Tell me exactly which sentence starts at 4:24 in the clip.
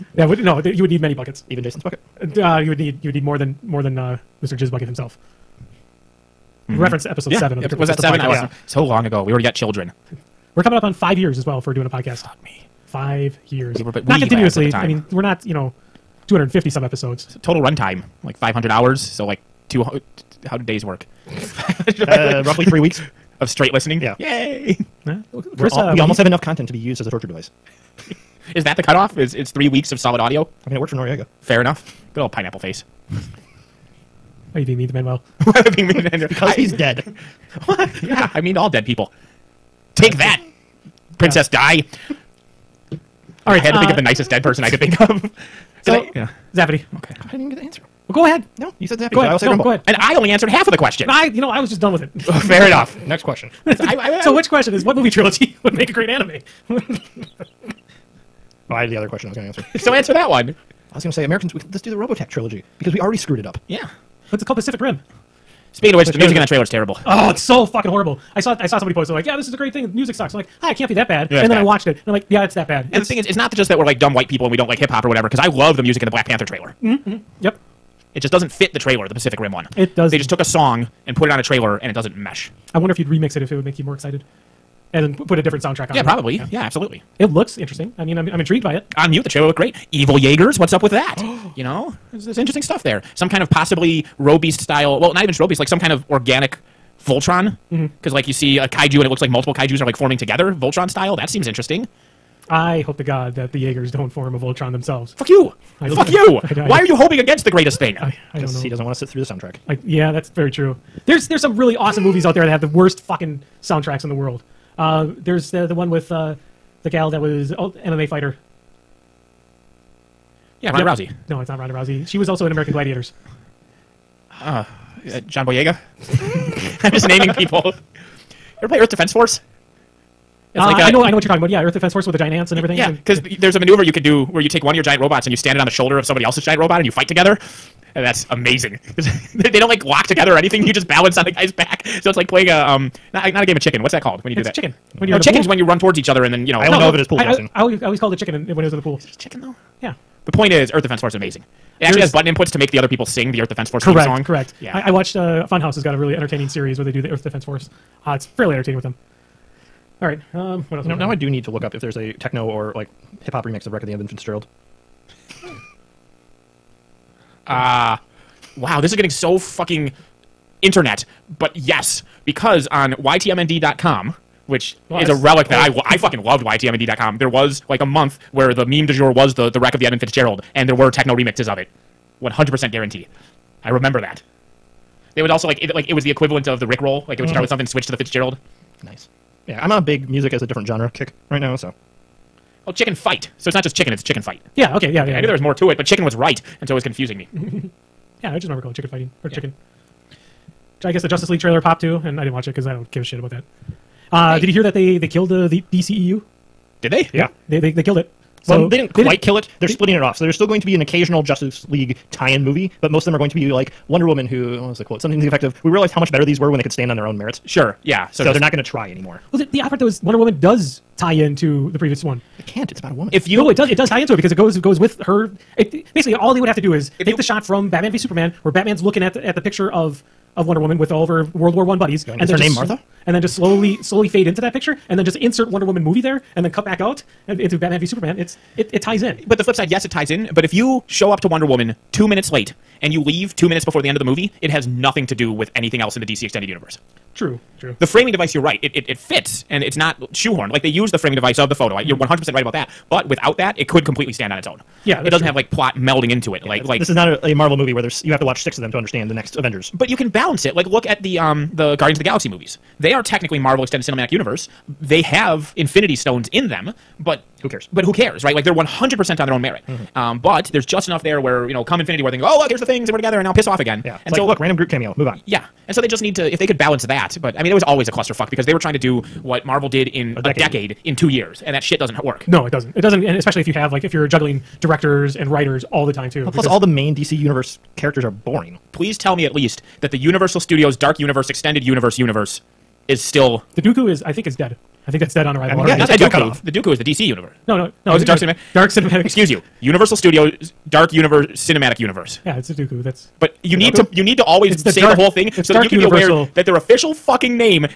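They have Infinity Stones in them, but who cares?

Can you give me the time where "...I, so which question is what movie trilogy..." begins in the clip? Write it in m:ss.
0:54.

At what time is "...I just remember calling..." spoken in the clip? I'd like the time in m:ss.
3:18.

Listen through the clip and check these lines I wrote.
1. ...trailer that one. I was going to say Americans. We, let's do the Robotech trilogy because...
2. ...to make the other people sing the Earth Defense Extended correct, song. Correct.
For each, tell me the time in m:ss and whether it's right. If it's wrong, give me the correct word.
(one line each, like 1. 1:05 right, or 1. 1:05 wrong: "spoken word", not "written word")
1. 0:59 wrong: "answer", not "trailer"
2. 2:32 wrong: "Force", not "Extended".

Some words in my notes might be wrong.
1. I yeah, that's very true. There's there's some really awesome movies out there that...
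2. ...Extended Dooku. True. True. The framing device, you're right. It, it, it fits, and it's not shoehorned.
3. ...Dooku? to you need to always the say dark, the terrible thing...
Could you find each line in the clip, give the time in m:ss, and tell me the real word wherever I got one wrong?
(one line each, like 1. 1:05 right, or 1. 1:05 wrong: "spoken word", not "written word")
1. 1:49 right
2. 4:06 wrong: "Universe", not "Dooku"
3. 5:03 wrong: "whole", not "terrible".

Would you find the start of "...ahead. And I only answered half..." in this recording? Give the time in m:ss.
0:49.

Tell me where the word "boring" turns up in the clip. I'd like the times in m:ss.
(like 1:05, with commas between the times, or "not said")
4:48.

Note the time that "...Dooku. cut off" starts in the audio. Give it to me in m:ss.
4:55.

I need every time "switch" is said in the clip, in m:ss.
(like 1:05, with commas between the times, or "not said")
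3:07.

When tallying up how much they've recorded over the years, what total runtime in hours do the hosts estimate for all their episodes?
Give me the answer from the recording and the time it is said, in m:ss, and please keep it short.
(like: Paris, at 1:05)
500, at 0:18.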